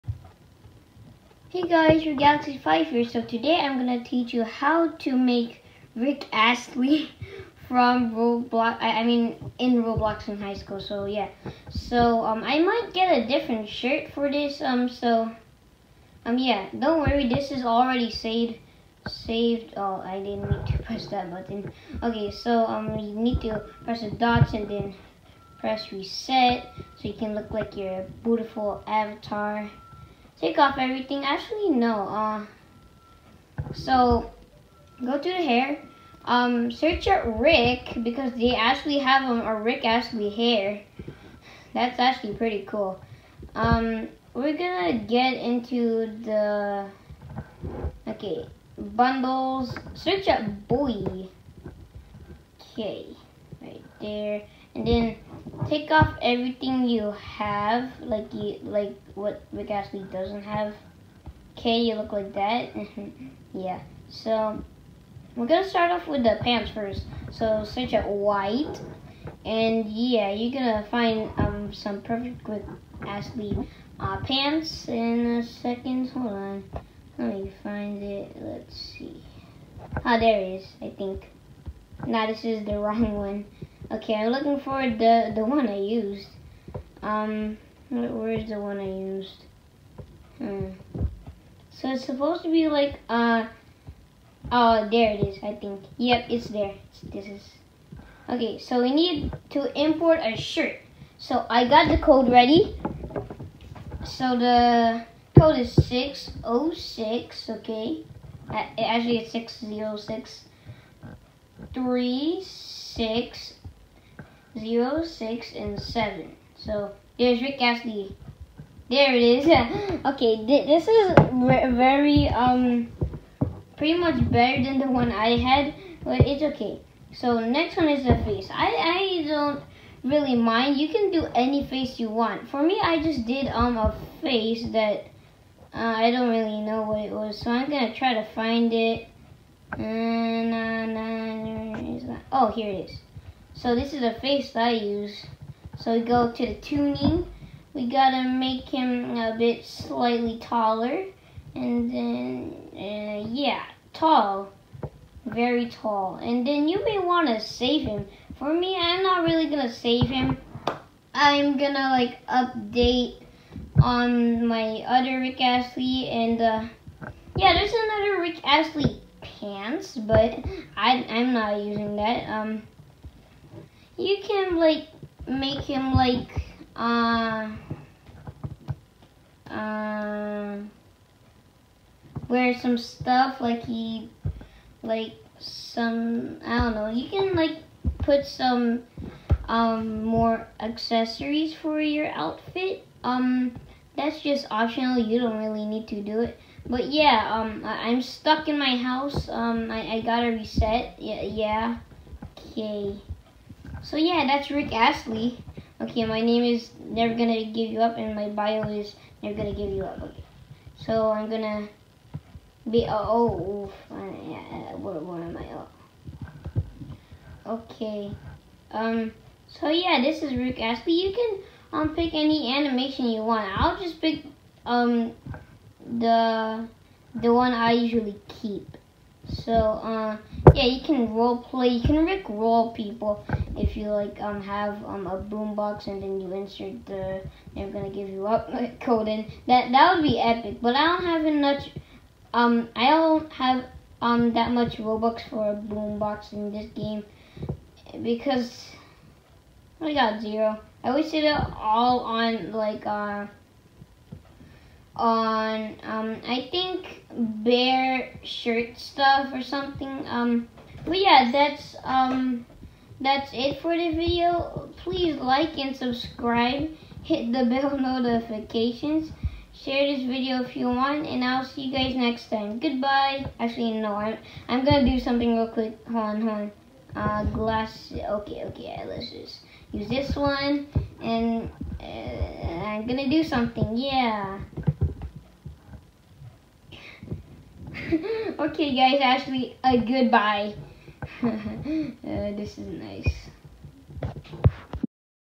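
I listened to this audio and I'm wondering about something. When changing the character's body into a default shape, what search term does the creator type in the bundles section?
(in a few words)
Boy.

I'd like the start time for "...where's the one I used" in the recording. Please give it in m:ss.
1:27.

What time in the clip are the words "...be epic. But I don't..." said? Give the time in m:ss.
4:00.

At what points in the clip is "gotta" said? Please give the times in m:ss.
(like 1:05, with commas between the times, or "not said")
2:27, 3:20.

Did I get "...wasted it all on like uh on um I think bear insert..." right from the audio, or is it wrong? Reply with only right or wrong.
wrong.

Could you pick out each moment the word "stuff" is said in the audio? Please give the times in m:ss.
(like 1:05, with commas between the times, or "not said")
3:02, 4:18.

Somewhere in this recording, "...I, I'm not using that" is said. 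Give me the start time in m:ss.
2:50.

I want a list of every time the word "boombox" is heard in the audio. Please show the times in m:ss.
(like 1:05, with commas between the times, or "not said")
3:55, 4:05.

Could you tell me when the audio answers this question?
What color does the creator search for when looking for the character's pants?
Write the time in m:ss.
1:08.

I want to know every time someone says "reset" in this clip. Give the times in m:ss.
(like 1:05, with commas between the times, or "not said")
0:25, 3:20.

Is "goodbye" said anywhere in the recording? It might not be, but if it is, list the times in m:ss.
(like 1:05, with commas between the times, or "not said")
4:32, 4:49.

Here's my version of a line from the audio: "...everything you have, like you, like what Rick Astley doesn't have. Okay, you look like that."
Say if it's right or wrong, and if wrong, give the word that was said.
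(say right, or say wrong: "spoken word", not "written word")
right.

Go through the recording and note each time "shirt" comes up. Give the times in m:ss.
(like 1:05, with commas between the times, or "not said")
0:13, 1:40, 4:18.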